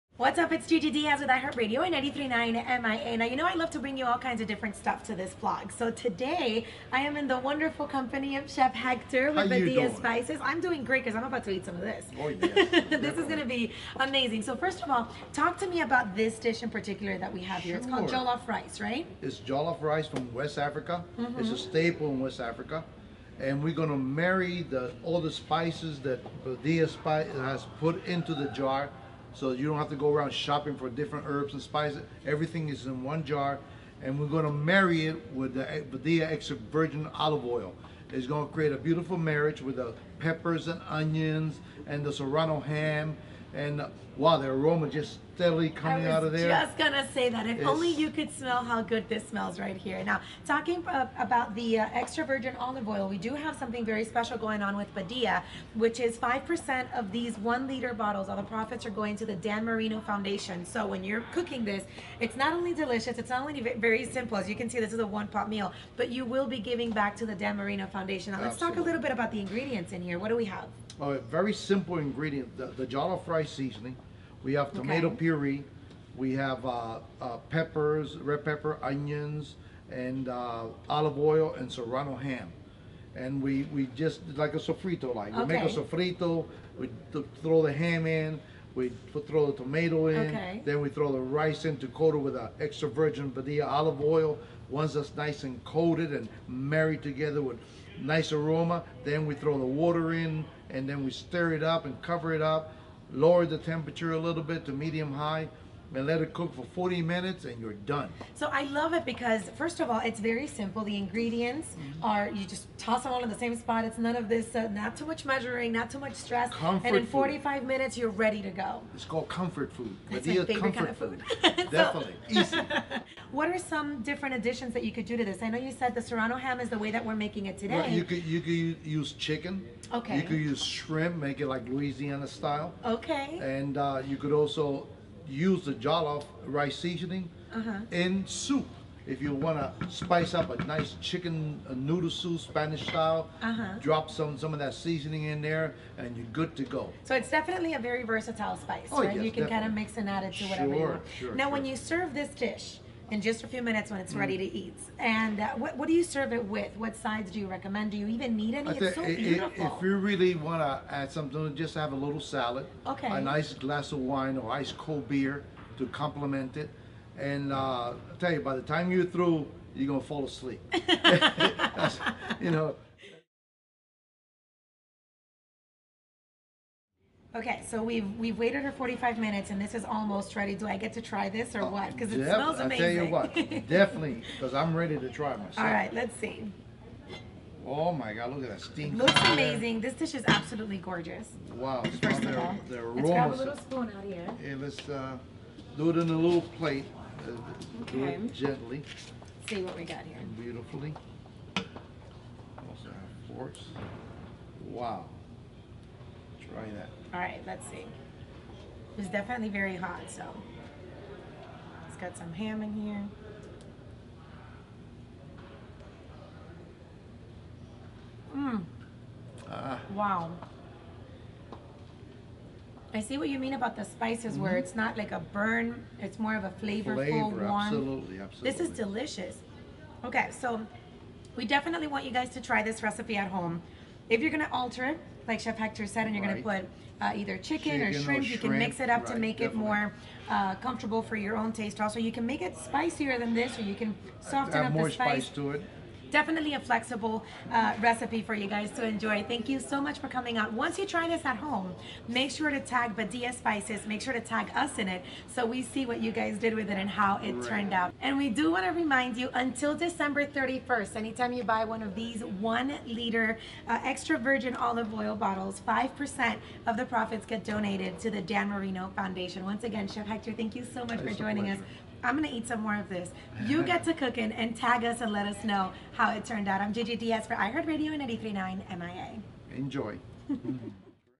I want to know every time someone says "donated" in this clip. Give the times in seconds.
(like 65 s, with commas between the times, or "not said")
267 s.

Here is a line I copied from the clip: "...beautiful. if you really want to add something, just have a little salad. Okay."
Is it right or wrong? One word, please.
right.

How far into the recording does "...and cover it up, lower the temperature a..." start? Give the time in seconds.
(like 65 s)
101 s.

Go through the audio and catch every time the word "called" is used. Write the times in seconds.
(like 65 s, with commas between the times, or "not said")
17 s, 119 s.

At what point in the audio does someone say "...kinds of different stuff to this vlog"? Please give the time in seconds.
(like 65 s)
4 s.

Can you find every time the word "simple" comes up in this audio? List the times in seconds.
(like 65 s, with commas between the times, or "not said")
64 s, 71 s, 110 s.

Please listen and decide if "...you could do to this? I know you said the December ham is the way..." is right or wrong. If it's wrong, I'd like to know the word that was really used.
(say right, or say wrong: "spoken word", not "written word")
wrong: "Serrano", not "December".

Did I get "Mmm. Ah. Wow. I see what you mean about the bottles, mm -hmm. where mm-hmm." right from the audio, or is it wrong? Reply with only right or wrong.
wrong.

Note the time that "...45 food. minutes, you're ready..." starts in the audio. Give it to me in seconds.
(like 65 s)
117 s.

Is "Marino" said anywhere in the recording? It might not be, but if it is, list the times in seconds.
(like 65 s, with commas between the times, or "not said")
59 s, 67 s, 268 s.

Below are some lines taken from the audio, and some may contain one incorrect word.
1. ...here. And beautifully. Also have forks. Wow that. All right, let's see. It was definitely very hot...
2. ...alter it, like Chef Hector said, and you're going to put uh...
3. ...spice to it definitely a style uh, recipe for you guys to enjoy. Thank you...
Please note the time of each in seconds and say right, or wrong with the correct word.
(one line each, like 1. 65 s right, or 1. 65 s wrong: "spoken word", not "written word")
1. 200 s right
2. 234 s right
3. 244 s wrong: "flexible", not "style".